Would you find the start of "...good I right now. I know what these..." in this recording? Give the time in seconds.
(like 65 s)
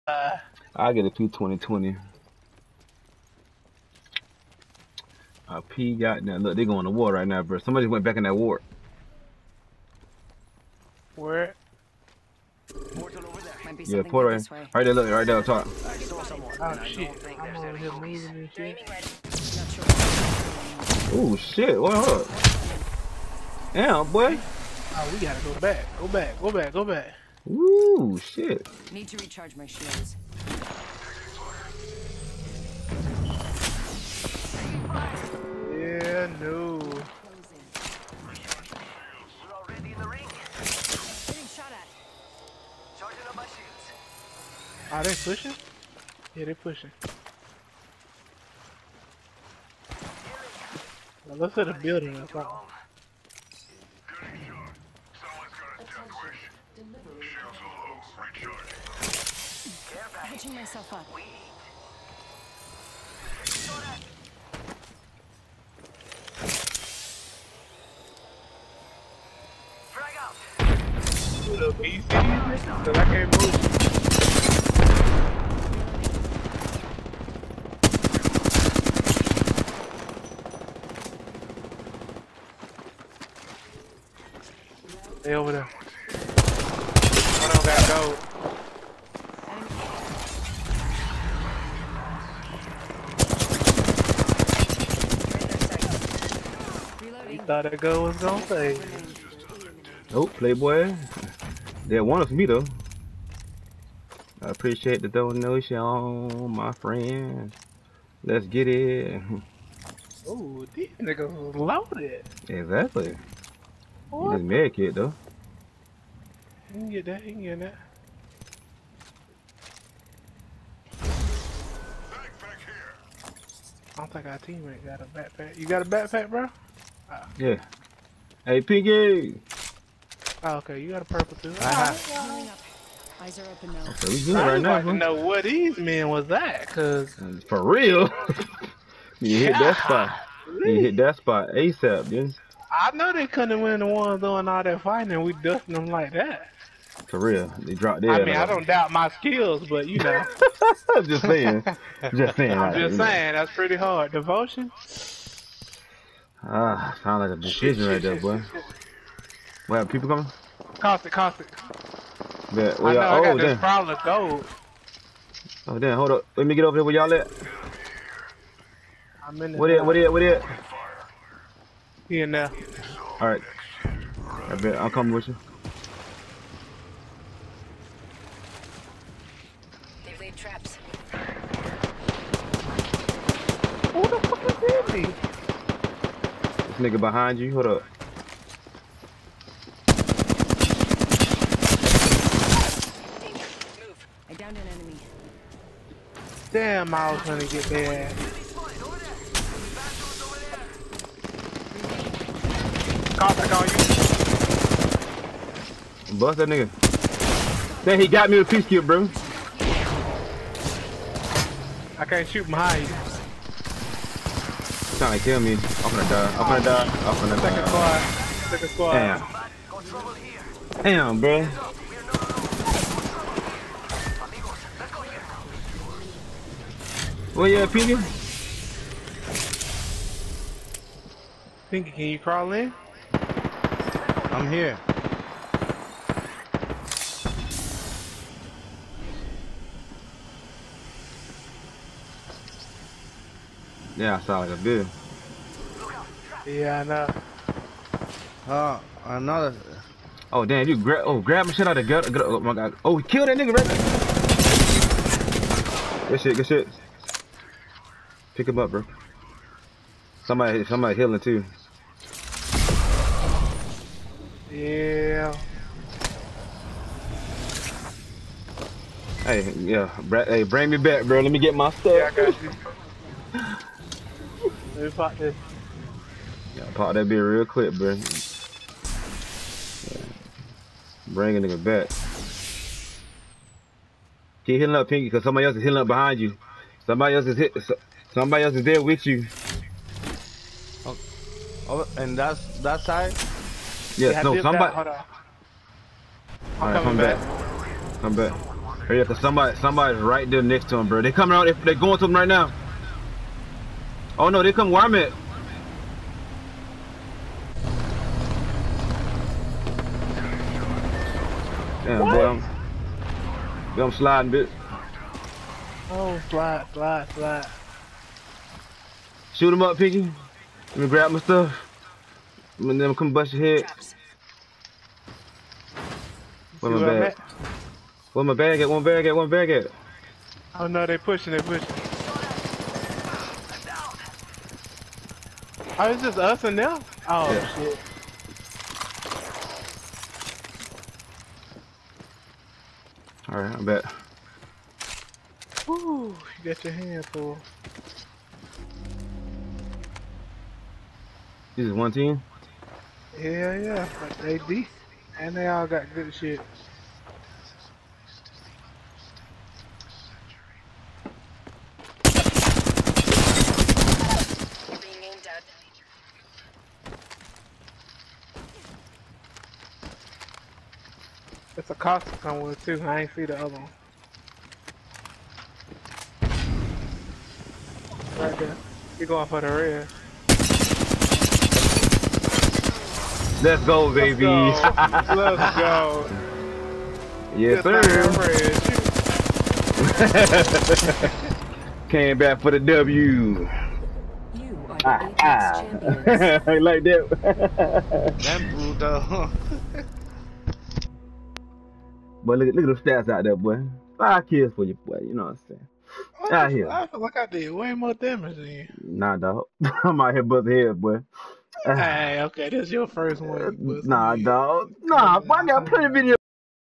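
134 s.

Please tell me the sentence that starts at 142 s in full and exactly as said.
I know they couldn't win the ones doing all that fighting, and we dusting them like that.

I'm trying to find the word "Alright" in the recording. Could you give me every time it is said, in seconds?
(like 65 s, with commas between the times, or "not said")
173 s, 343 s.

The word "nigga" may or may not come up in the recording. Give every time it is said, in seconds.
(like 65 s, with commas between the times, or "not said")
110 s, 186 s, 206 s, 253 s, 281 s.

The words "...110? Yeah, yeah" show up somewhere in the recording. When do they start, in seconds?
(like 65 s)
351 s.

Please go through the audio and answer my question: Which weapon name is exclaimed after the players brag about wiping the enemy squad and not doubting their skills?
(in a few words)
Devotion.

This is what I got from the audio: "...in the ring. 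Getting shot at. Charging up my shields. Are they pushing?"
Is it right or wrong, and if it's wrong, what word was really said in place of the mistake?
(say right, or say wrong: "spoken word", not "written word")
right.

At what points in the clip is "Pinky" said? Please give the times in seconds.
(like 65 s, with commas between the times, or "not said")
128 s, 227 s, 231 s, 284 s.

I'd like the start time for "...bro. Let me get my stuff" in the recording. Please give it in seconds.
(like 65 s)
271 s.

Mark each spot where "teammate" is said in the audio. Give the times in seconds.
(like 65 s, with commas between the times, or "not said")
124 s.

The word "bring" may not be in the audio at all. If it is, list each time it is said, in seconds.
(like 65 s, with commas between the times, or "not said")
270 s, 281 s.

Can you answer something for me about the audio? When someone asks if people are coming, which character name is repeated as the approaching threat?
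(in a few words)
Caustic.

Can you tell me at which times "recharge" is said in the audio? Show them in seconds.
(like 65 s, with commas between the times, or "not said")
29 s.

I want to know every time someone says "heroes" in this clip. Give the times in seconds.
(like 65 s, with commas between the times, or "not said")
not said.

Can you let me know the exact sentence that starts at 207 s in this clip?
Then he got me with peace kill, bro.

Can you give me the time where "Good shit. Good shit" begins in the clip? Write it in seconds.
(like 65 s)
256 s.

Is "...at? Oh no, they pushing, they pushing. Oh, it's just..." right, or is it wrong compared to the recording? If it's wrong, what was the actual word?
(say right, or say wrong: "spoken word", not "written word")
right.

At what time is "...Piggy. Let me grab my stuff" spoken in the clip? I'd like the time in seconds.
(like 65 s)
319 s.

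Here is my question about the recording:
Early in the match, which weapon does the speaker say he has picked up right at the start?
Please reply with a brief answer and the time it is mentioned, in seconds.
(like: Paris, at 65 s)
P2020, at 1 s.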